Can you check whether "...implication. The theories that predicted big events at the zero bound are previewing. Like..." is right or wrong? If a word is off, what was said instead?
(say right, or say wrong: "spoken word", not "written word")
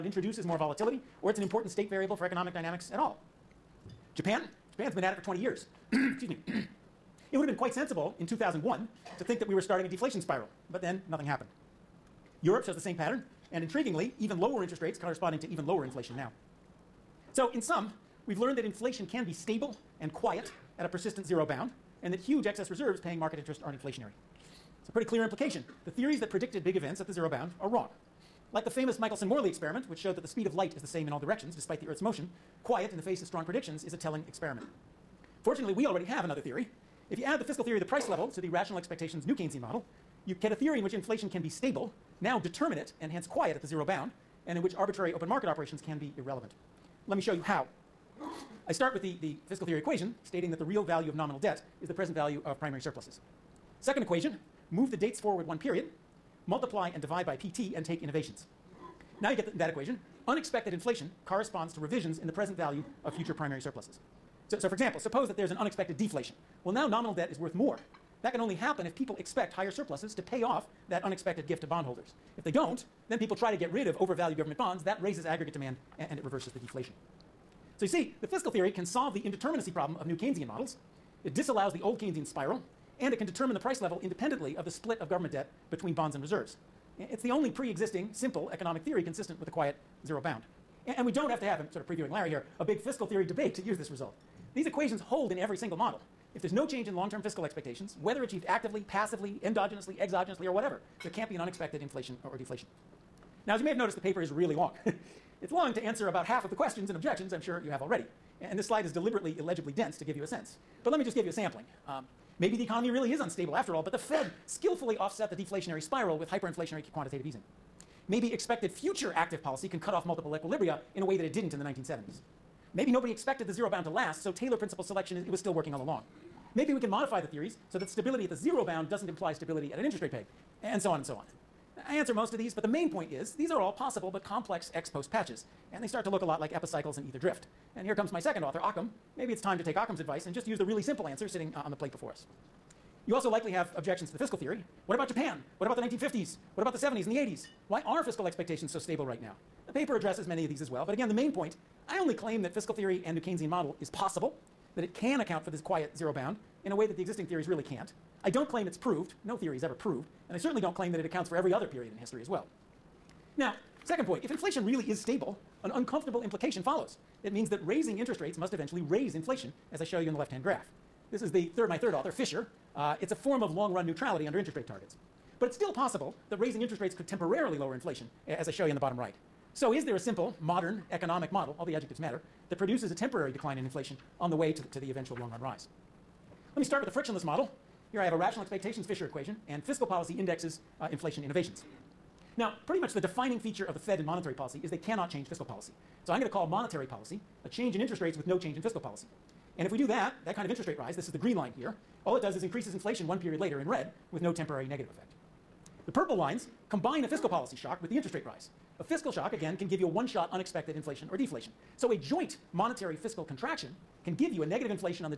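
wrong: "wrong", not "previewing".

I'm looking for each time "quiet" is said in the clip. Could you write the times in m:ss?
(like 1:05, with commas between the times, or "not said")
0:20, 0:32, 0:43, 1:29, 2:35.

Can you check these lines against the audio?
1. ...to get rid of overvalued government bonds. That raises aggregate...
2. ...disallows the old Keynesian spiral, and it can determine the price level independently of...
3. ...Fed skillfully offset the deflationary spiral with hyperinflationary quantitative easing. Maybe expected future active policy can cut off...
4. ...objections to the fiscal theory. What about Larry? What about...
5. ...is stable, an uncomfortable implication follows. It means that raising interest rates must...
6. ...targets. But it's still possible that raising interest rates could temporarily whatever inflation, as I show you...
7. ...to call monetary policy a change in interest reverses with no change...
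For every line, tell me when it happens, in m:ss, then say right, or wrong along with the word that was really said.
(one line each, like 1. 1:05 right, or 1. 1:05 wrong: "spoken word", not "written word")
1. 1:13 right
2. 1:21 right
3. 1:53 right
4. 2:23 wrong: "Japan", not "Larry"
5. 2:44 right
6. 2:54 wrong: "lower", not "whatever"
7. 3:16 wrong: "rates", not "reverses".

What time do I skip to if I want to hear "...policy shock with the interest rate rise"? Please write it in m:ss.
3:27.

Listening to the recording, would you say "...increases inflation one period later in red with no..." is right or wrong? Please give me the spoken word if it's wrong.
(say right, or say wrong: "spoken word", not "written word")
right.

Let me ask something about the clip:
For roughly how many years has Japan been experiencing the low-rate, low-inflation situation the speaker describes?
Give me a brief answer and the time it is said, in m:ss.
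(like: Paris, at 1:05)
20 years, at 0:05.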